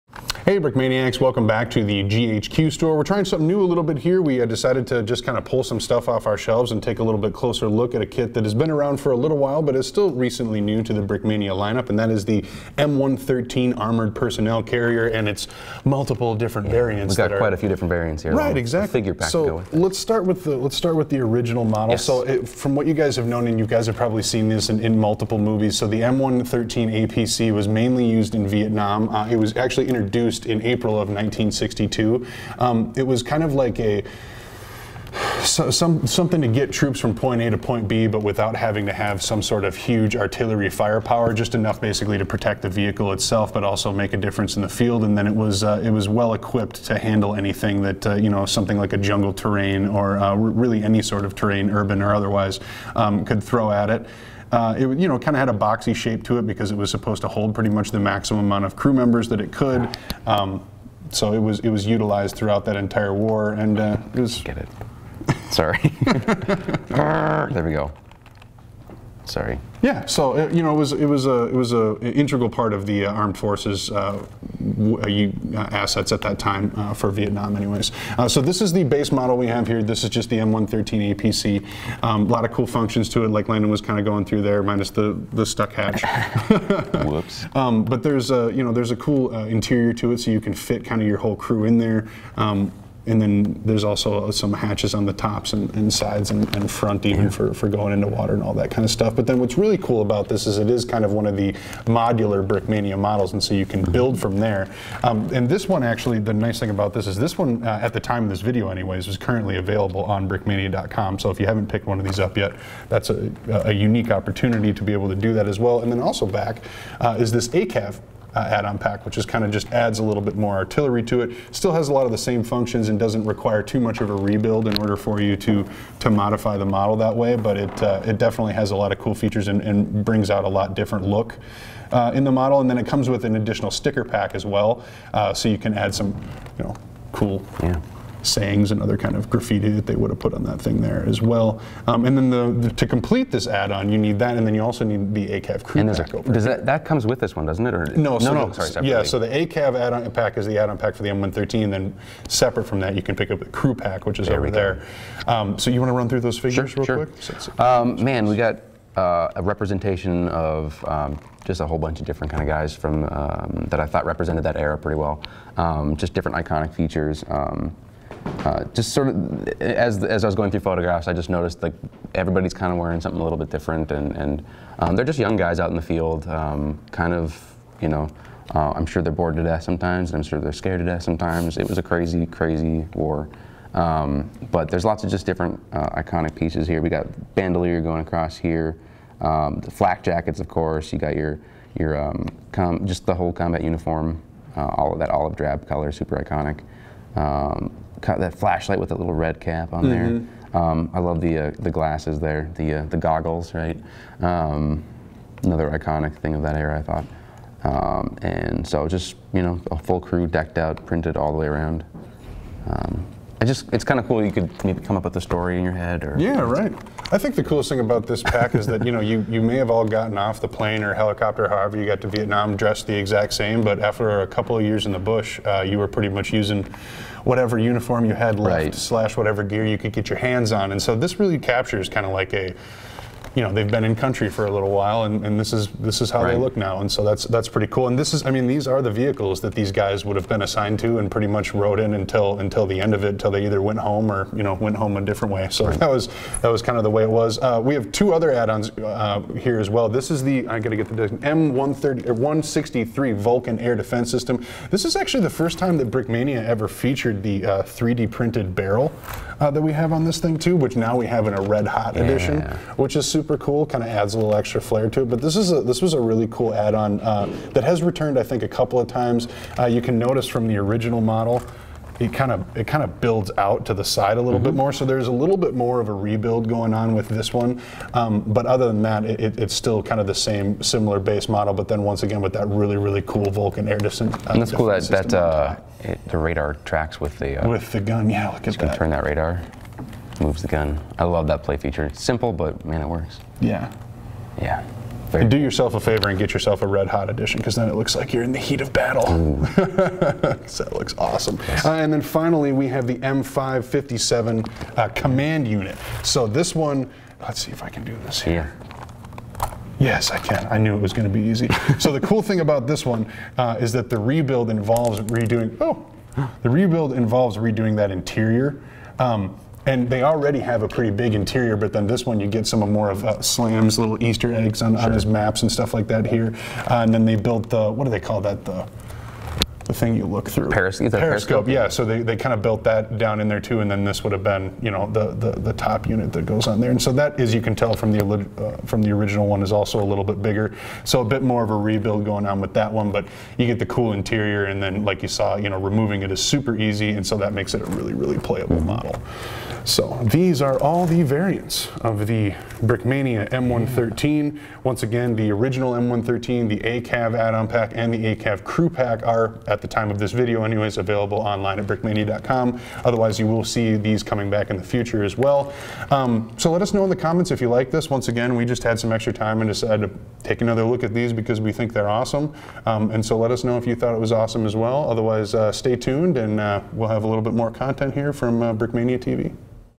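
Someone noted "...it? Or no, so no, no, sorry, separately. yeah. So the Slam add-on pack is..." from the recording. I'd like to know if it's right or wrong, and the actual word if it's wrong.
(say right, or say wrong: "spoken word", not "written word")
wrong: "ACAV", not "Slam".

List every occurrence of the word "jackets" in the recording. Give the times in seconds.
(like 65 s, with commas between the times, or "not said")
190 s.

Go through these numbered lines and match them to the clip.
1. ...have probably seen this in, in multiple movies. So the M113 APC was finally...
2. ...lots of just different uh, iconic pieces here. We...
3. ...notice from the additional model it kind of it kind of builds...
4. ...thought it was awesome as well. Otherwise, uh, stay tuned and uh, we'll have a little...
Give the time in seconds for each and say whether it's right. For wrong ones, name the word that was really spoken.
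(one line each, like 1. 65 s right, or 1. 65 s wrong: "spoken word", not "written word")
1. 23 s wrong: "mainly", not "finally"
2. 184 s right
3. 269 s wrong: "original", not "additional"
4. 373 s right.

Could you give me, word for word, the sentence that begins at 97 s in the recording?
for, for going into water and all that kind of stuff.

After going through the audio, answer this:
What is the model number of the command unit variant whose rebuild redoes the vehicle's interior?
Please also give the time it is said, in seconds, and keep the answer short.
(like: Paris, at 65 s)
M557, at 302 s.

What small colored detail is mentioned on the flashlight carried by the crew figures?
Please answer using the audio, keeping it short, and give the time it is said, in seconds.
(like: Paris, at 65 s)
red cap, at 199 s.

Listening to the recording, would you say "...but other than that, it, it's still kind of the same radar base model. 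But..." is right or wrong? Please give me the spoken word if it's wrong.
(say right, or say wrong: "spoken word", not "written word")
wrong: "similar", not "radar".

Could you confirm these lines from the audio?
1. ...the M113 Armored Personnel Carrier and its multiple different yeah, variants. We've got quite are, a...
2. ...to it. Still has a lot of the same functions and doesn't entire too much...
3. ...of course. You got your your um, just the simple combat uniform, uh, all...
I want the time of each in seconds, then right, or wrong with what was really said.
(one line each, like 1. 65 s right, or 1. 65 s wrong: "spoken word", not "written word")
1. 12 s right
2. 121 s wrong: "require", not "entire"
3. 190 s wrong: "whole", not "simple".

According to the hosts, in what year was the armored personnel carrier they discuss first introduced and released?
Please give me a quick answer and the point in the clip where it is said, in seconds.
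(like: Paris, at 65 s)
1962, at 31 s.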